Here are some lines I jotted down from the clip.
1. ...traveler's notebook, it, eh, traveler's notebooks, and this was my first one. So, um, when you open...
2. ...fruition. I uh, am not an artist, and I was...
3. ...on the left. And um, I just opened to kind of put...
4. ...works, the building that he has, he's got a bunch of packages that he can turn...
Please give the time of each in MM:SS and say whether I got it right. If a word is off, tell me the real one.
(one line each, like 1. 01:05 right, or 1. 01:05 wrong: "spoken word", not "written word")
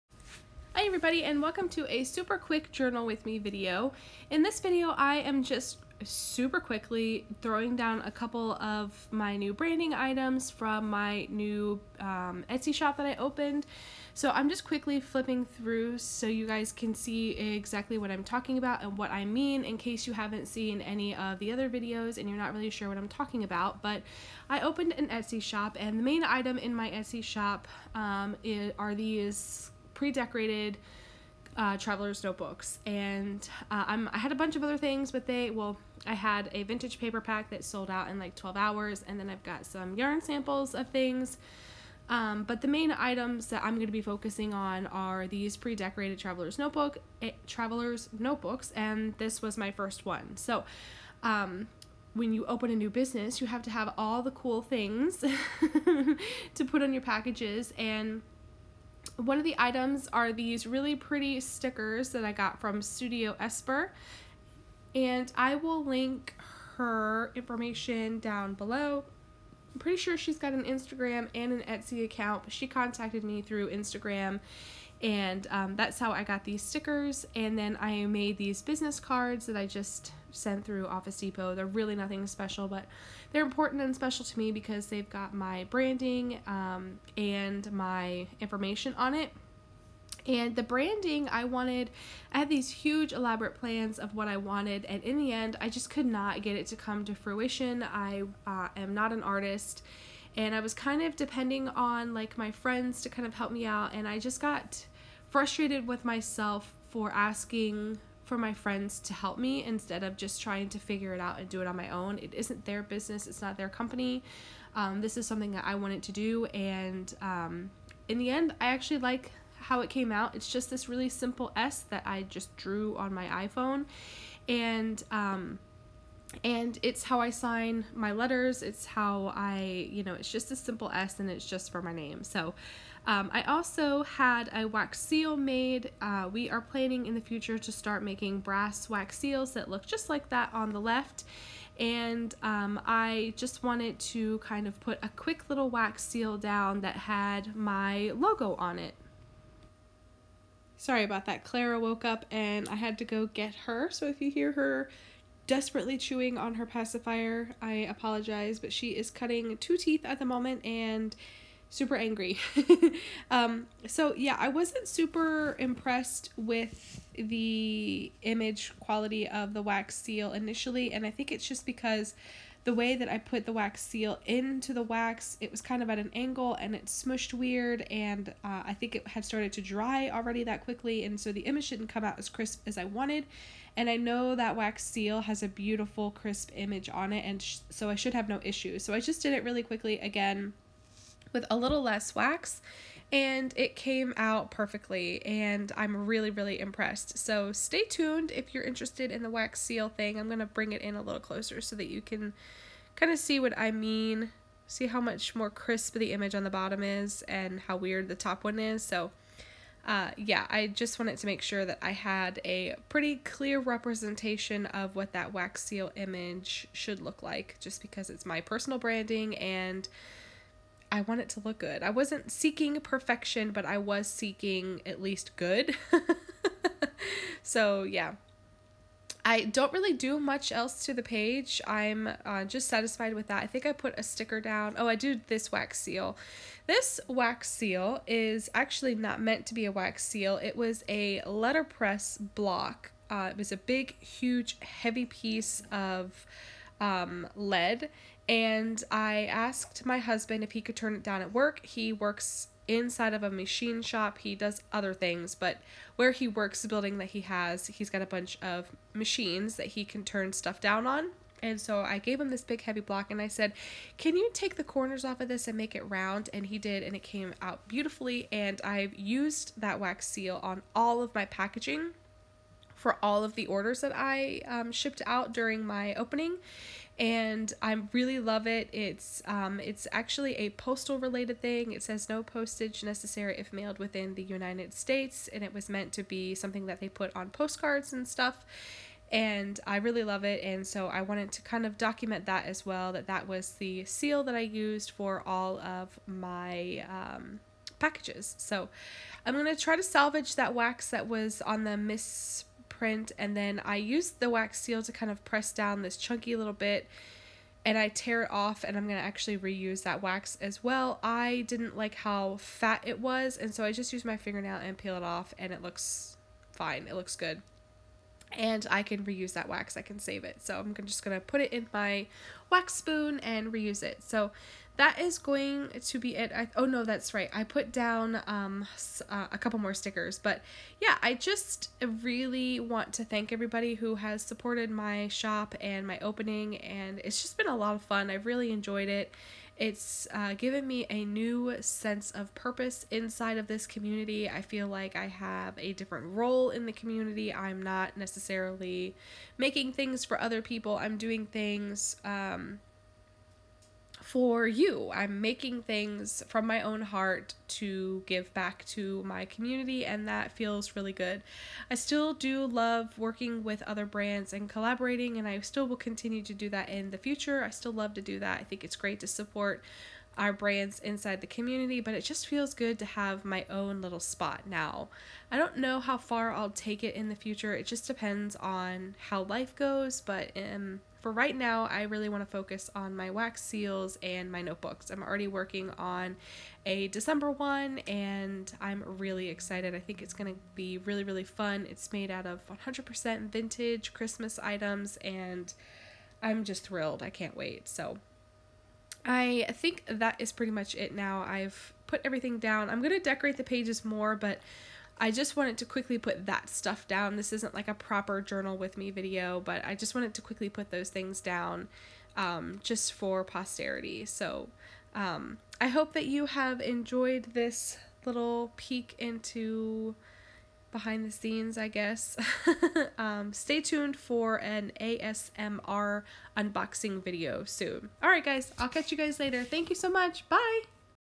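1. 00:46 right
2. 01:37 right
3. 02:20 wrong: "wanted", not "opened"
4. 04:16 wrong: "machines", not "packages".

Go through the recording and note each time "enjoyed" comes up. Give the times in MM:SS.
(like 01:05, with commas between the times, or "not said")
05:38, 06:56.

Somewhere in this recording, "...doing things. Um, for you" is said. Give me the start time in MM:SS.
05:50.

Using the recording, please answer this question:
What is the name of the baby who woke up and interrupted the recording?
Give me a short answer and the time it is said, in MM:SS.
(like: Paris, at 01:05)
Clara, at 02:31.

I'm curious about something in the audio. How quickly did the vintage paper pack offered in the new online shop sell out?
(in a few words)
12 hours.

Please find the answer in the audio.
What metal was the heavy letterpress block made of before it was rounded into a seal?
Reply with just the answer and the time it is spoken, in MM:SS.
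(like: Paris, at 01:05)
lead, at 04:07.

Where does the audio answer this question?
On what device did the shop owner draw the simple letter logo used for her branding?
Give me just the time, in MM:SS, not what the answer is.
02:03.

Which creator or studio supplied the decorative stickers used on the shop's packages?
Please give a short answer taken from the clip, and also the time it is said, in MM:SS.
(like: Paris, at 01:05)
Studio Esper, at 01:02.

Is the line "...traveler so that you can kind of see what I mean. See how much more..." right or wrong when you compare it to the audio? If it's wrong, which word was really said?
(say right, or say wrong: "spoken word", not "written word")
wrong: "closer", not "traveler".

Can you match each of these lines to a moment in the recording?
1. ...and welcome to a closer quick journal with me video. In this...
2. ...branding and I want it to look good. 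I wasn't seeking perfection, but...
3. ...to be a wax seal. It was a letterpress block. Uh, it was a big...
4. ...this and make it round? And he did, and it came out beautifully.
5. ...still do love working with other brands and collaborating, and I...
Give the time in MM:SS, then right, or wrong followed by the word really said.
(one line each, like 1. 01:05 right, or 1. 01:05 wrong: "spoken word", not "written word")
1. 00:01 wrong: "super", not "closer"
2. 03:38 right
3. 03:59 right
4. 04:25 right
5. 06:01 right.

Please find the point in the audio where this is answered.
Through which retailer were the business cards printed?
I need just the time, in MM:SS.
01:20.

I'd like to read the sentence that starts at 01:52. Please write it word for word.
It isn't their business, it's not their company.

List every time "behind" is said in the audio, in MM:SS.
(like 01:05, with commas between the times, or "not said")
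07:00.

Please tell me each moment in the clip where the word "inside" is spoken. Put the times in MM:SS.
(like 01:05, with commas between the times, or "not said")
04:12, 05:42, 06:10.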